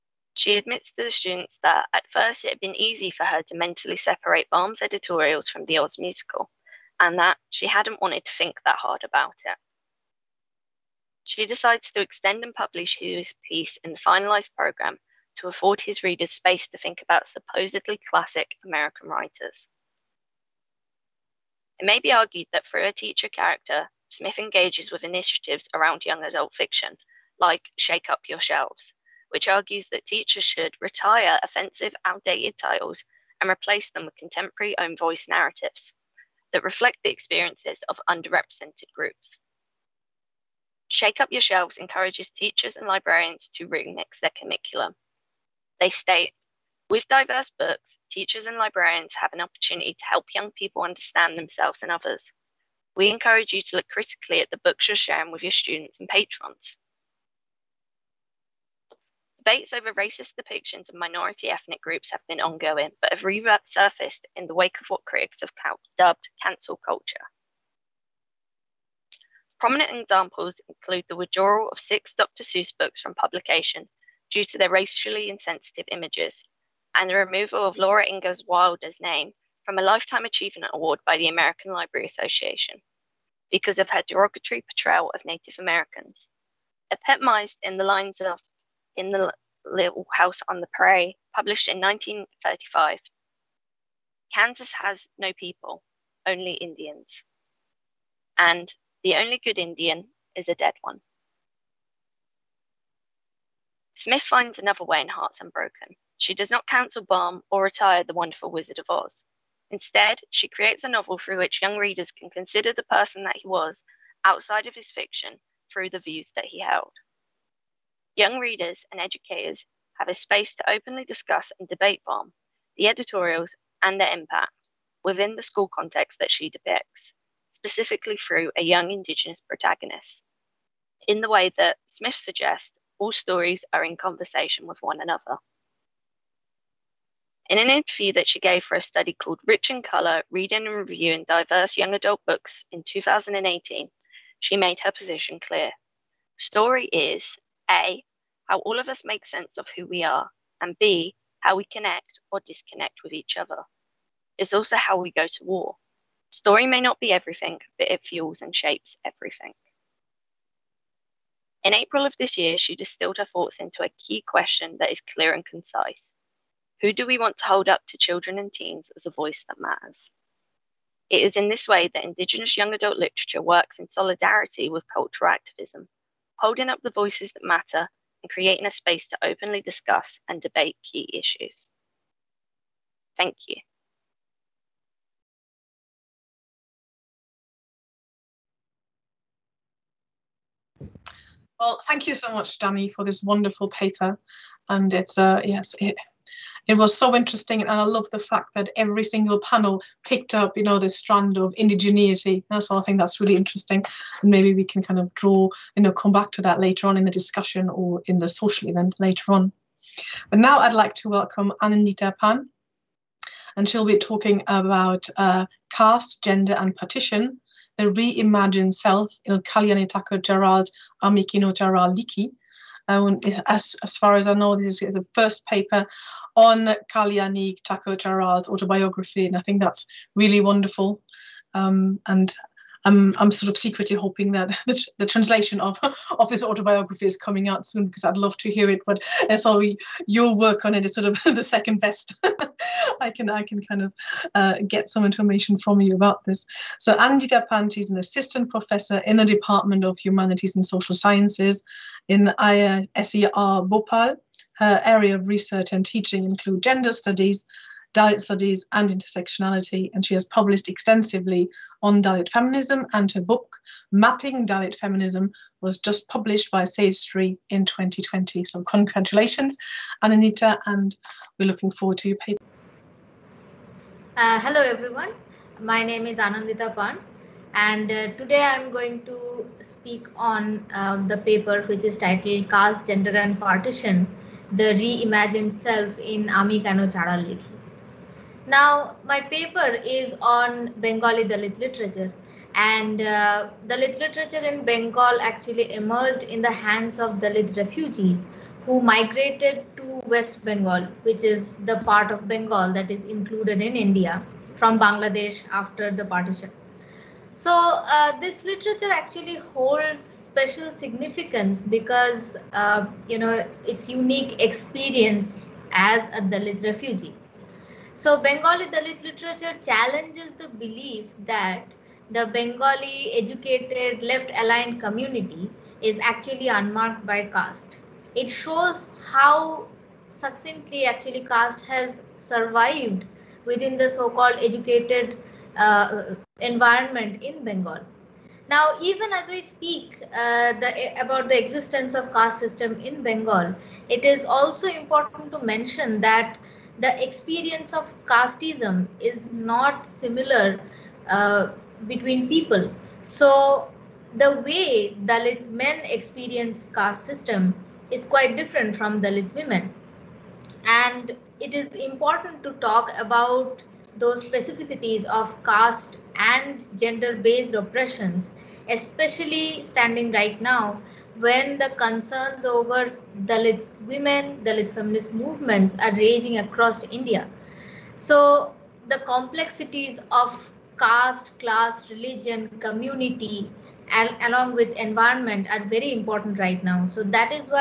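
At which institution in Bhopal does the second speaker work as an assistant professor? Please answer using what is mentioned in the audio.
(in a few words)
IISER Bhopal.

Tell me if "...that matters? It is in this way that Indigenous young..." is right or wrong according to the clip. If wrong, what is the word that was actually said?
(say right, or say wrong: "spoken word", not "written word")
right.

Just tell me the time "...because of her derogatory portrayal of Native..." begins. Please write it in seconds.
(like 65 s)
83 s.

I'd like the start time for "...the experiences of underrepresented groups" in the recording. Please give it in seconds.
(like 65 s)
37 s.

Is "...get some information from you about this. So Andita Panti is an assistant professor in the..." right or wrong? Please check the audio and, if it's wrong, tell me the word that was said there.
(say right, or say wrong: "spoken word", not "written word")
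right.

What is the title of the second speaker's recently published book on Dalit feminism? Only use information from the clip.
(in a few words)
Mapping Dalit Feminism.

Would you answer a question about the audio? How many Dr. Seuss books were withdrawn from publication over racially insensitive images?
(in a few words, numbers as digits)
6.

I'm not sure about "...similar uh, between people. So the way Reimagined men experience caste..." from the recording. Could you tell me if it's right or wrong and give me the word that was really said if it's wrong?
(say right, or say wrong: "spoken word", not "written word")
wrong: "Dalit", not "Reimagined".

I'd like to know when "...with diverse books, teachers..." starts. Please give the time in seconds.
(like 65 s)
46 s.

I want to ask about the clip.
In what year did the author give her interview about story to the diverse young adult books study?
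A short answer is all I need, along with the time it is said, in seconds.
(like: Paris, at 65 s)
2018, at 142 s.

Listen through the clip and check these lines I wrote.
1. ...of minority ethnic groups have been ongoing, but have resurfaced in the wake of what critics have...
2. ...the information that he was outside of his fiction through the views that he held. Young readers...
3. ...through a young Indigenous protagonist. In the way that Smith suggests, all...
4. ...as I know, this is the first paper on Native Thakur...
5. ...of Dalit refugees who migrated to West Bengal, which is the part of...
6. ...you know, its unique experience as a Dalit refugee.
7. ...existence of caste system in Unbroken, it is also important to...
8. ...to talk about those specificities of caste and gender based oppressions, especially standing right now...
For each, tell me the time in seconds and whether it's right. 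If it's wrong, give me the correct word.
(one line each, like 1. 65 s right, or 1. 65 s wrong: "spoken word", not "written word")
1. 60 s right
2. 112 s wrong: "person", not "information"
3. 128 s right
4. 224 s wrong: "Kalyani", not "Native"
5. 296 s right
6. 313 s right
7. 341 s wrong: "Bengal", not "Unbroken"
8. 362 s right.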